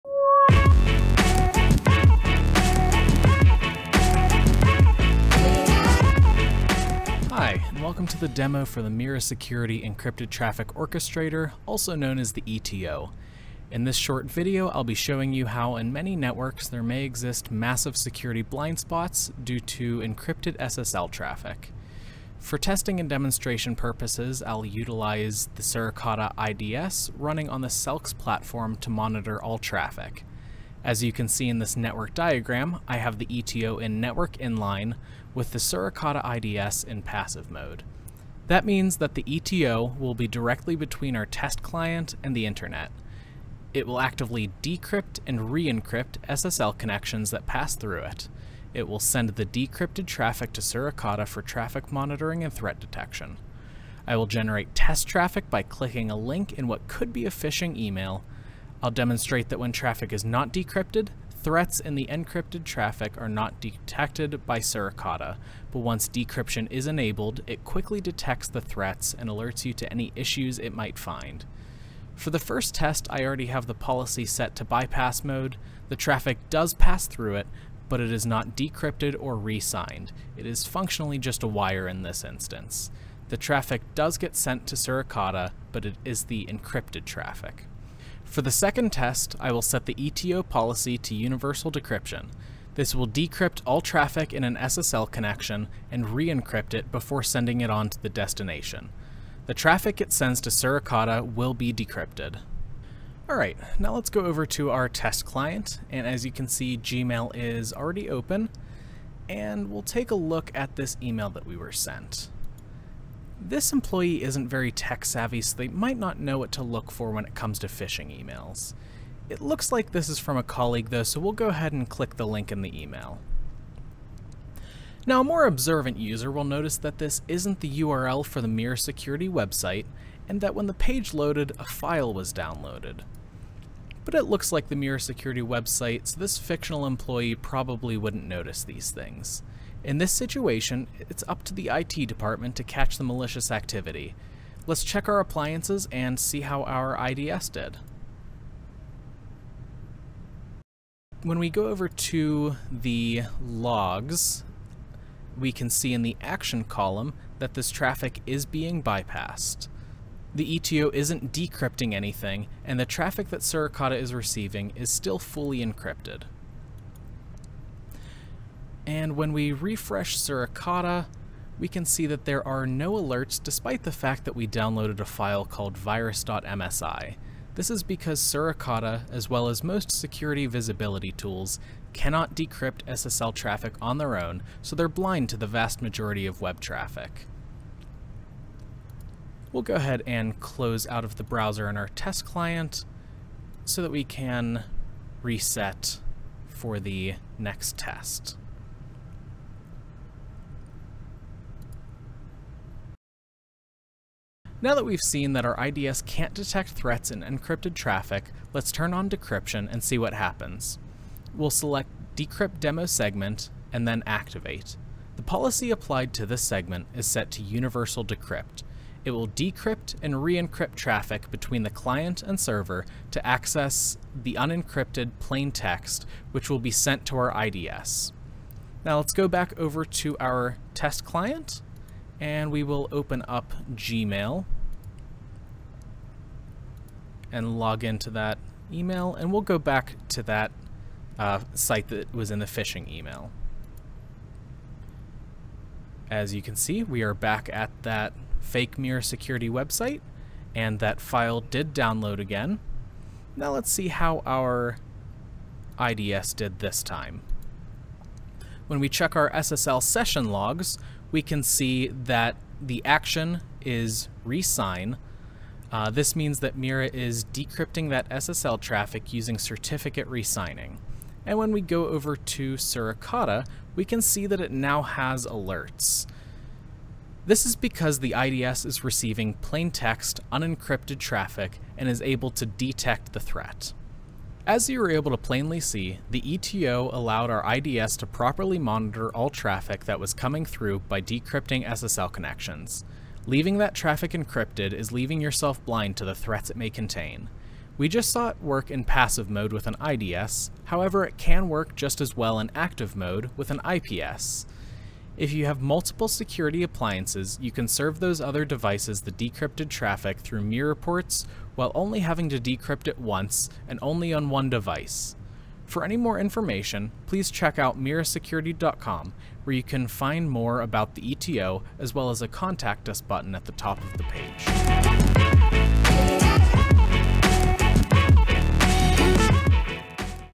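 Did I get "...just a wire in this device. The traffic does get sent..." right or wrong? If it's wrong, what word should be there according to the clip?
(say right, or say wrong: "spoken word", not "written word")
wrong: "instance", not "device".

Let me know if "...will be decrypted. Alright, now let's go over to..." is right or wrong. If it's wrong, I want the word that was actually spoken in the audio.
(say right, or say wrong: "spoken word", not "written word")
right.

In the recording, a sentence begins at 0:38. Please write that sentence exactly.
That means that the ETO will be directly between our test client and the internet.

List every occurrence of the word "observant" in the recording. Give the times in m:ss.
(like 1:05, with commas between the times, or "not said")
2:05.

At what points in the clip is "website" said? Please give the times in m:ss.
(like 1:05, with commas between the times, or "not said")
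2:09, 2:15, 4:09.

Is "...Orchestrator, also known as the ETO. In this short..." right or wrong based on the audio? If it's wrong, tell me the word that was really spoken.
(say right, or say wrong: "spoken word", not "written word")
right.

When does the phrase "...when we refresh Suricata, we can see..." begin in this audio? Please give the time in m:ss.
2:49.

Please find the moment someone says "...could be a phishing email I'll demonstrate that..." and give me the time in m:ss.
0:56.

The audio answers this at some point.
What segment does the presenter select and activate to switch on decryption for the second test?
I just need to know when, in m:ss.
3:32.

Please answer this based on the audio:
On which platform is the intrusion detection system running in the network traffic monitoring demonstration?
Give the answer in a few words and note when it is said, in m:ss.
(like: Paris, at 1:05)
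SELKS, at 0:27.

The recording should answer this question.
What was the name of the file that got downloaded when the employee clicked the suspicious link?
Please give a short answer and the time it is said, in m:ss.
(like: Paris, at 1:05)
virus.msi, at 2:55.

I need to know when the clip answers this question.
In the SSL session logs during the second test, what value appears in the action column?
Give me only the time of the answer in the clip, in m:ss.
4:24.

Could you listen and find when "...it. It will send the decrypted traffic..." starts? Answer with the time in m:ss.
0:48.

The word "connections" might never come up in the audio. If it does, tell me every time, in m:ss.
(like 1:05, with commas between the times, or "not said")
0:46, 1:35, 4:52.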